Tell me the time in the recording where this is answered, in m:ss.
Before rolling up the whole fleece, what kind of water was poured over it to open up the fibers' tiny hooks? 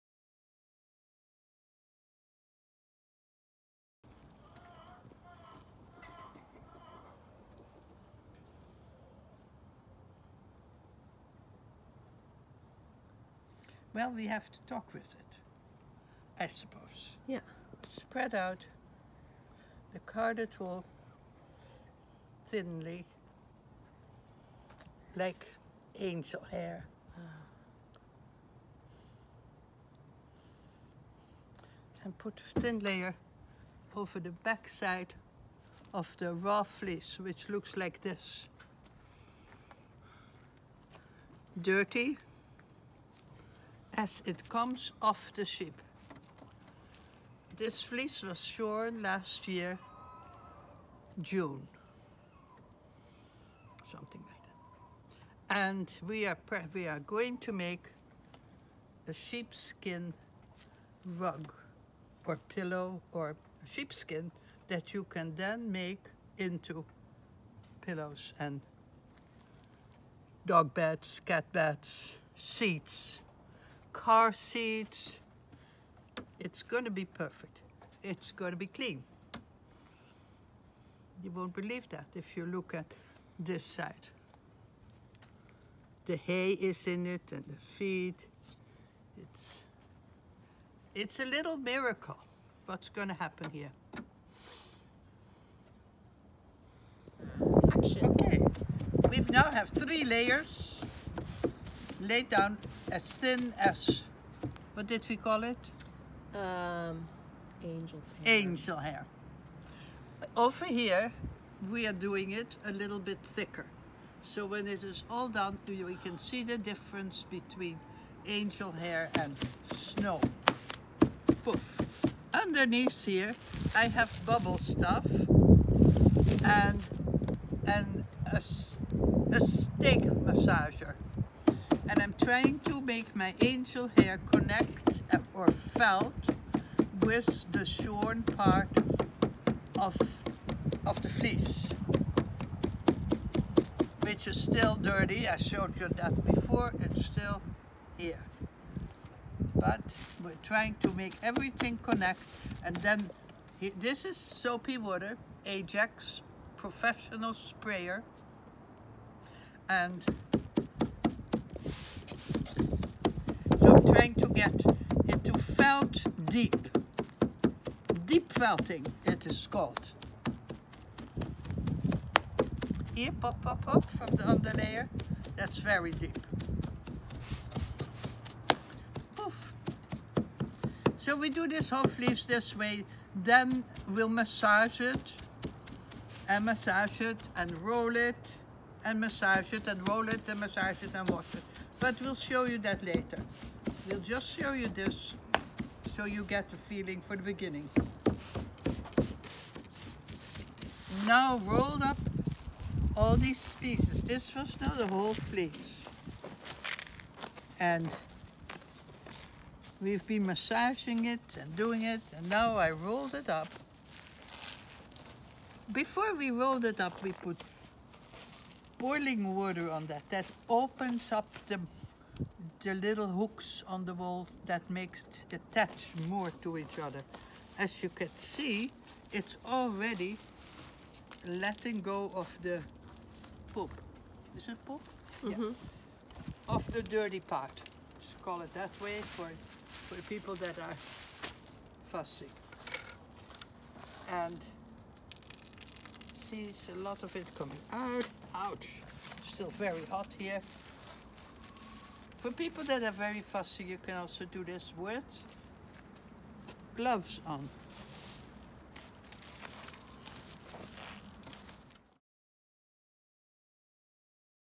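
3:38.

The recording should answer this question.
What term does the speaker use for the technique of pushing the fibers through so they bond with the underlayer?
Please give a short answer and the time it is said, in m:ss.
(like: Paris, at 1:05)
Deep felting, at 2:48.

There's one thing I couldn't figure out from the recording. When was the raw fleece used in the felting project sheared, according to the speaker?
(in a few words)
Last year, June.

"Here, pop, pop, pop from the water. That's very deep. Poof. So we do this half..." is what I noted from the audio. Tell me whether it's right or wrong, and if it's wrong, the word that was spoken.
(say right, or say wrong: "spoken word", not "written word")
wrong: "underlayer", not "water".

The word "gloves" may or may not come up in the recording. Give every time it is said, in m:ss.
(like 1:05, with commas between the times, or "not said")
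4:16.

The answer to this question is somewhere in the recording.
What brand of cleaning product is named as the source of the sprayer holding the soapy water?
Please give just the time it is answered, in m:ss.
2:35.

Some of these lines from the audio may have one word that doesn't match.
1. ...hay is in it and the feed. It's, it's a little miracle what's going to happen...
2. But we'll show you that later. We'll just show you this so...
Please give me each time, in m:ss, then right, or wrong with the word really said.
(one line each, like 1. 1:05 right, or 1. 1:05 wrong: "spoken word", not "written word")
1. 1:26 right
2. 3:11 right.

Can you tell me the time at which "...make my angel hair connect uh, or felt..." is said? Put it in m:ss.
2:12.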